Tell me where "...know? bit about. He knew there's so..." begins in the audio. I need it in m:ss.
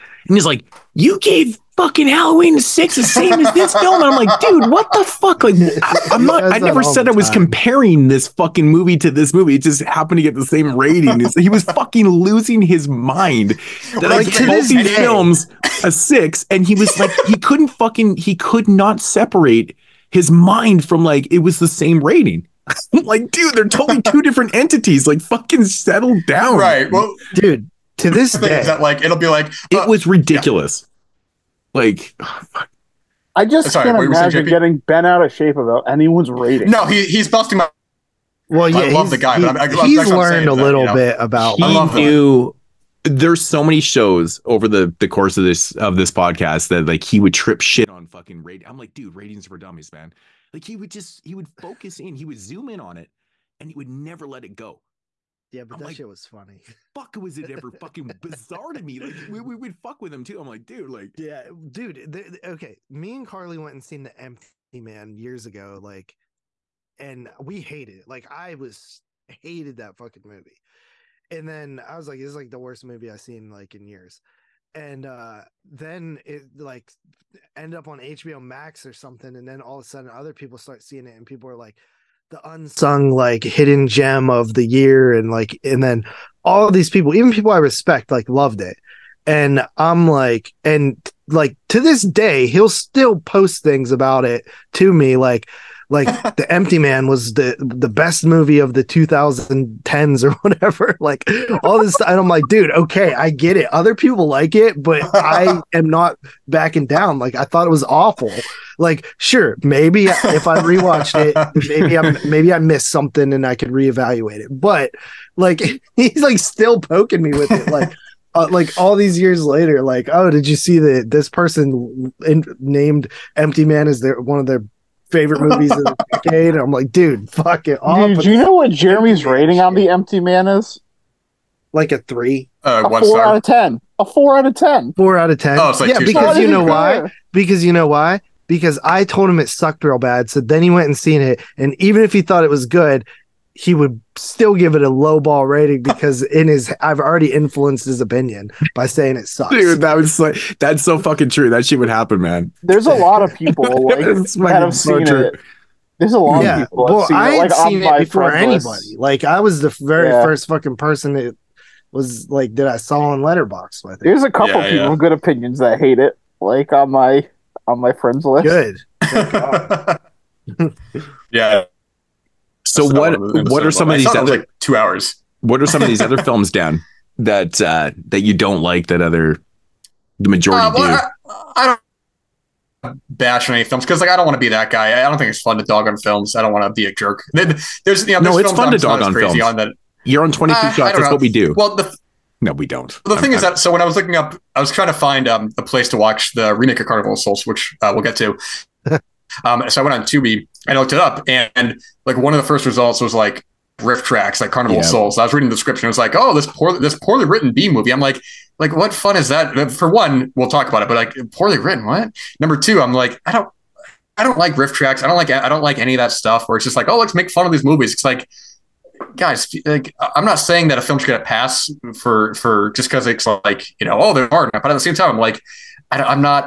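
0:41.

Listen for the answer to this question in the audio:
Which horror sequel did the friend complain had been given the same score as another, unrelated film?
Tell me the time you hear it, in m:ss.
0:02.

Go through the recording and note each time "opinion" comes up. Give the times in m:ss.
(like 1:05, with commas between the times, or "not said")
2:28, 2:45.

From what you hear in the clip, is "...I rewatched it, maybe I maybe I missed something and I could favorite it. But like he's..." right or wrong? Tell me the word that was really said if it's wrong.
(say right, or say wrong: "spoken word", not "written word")
wrong: "reevaluate", not "favorite".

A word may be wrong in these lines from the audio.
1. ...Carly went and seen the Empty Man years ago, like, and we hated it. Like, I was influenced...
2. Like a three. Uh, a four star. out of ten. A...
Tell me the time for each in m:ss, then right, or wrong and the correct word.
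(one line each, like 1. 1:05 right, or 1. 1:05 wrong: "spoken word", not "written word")
1. 1:03 wrong: "hated", not "influenced"
2. 2:11 right.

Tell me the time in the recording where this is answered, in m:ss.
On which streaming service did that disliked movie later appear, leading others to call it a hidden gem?
1:17.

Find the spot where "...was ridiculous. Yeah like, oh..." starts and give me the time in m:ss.
0:29.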